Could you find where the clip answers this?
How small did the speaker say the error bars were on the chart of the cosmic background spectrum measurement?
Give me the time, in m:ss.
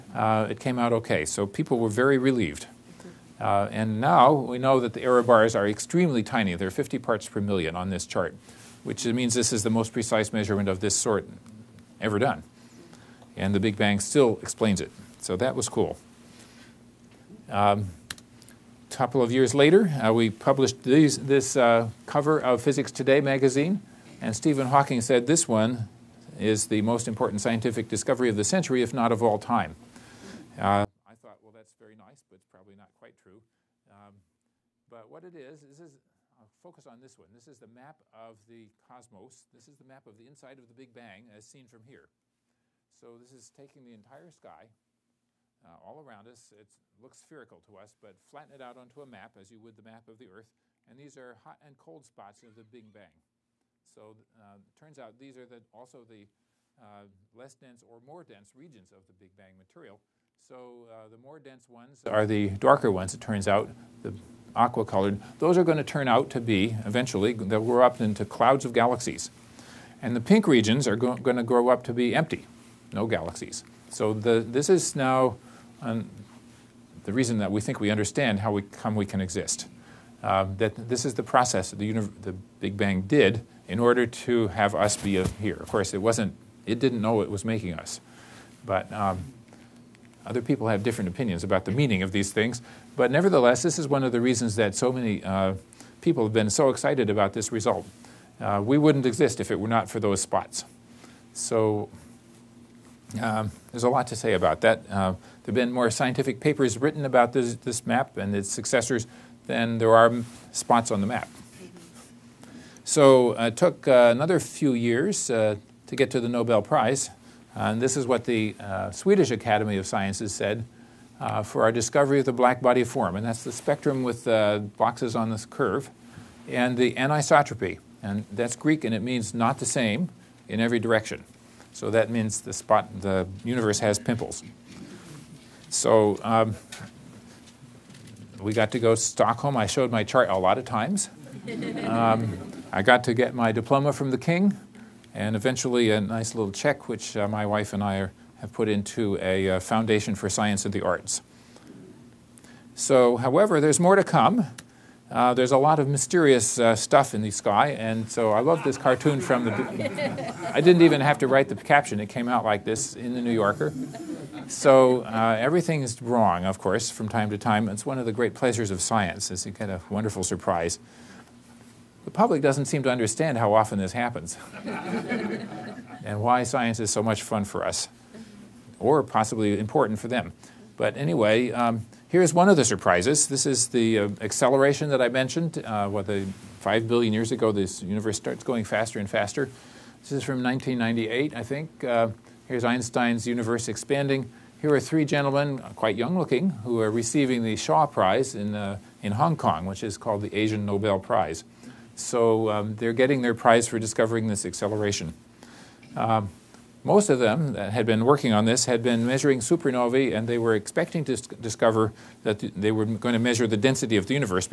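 0:06.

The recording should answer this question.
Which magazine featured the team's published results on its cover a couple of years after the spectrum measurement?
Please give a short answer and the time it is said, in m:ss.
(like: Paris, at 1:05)
Physics Today, at 0:22.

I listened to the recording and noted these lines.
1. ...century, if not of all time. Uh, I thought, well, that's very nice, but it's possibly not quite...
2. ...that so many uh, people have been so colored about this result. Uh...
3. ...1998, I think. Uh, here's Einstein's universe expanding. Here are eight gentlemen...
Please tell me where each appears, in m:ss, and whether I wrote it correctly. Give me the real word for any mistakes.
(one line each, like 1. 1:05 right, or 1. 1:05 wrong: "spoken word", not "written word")
1. 0:28 wrong: "probably", not "possibly"
2. 1:34 wrong: "excited", not "colored"
3. 3:10 wrong: "three", not "eight".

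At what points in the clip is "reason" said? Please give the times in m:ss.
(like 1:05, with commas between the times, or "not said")
1:17, 1:34.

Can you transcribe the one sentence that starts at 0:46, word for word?
It looks spherical to us, but flatten it out onto a map as you would the map of the Earth.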